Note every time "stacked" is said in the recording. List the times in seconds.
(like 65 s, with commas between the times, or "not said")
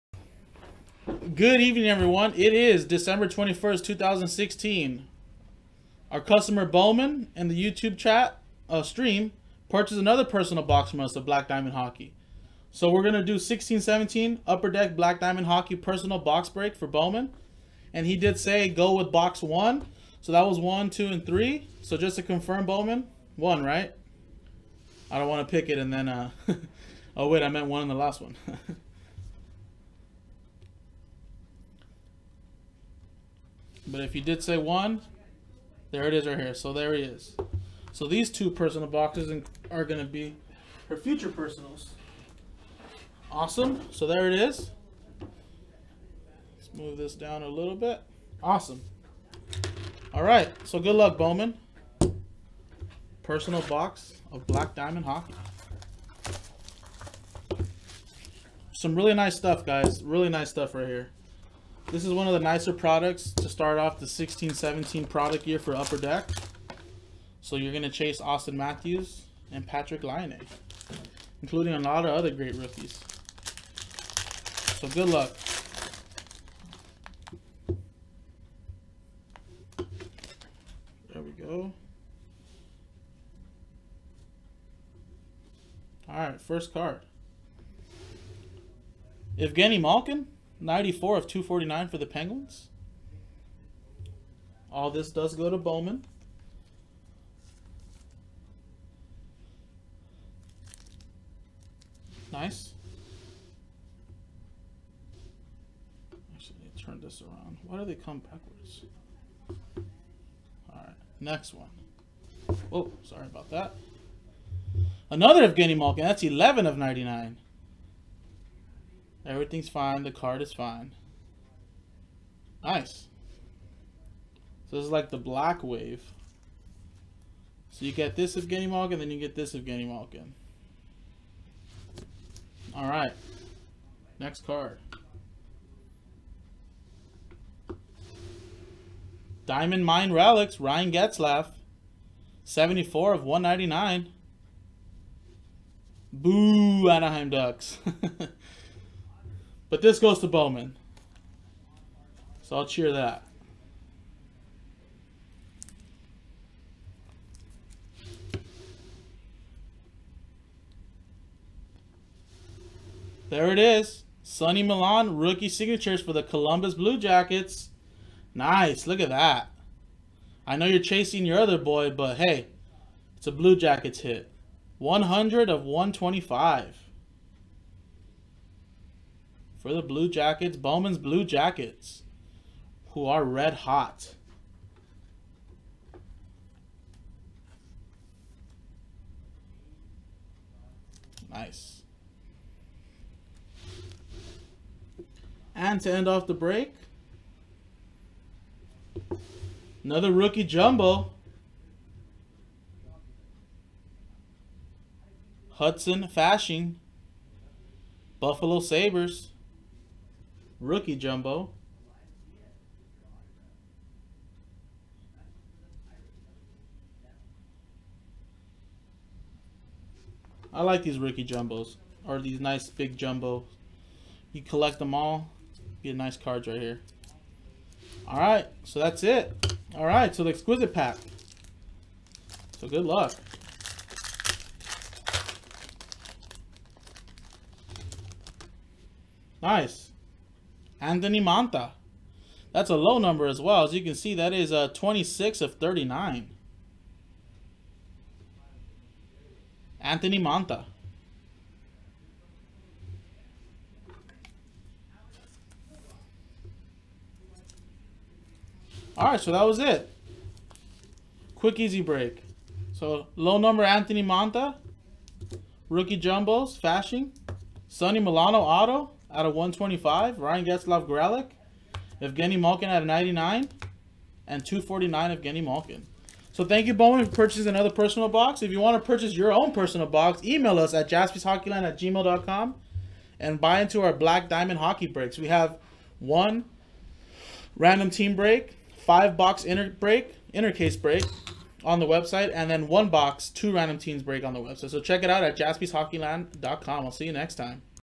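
not said.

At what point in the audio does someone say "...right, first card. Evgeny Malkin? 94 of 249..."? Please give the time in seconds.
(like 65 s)
86 s.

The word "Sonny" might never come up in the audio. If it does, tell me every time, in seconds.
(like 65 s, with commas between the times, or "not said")
164 s, 267 s.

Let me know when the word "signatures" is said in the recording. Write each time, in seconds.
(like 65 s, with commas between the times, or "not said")
165 s.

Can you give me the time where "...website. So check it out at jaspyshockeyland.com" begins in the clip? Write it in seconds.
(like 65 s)
294 s.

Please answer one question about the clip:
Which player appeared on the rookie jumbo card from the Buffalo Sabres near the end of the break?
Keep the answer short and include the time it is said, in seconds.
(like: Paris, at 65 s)
Hudson Fasching, at 205 s.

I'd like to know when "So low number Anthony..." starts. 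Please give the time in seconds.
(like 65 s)
262 s.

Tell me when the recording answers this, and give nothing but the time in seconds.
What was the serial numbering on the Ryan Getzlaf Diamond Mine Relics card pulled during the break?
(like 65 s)
142 s.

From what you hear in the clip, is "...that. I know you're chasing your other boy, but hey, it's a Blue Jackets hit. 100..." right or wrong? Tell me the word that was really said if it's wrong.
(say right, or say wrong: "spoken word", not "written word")
right.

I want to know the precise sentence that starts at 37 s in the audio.
So these two personal boxes are going to be her future personals.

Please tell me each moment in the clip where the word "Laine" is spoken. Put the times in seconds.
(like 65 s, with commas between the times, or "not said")
70 s.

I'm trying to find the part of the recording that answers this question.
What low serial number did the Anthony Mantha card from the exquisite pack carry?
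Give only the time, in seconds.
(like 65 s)
244 s.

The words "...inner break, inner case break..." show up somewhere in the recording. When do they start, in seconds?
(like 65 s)
289 s.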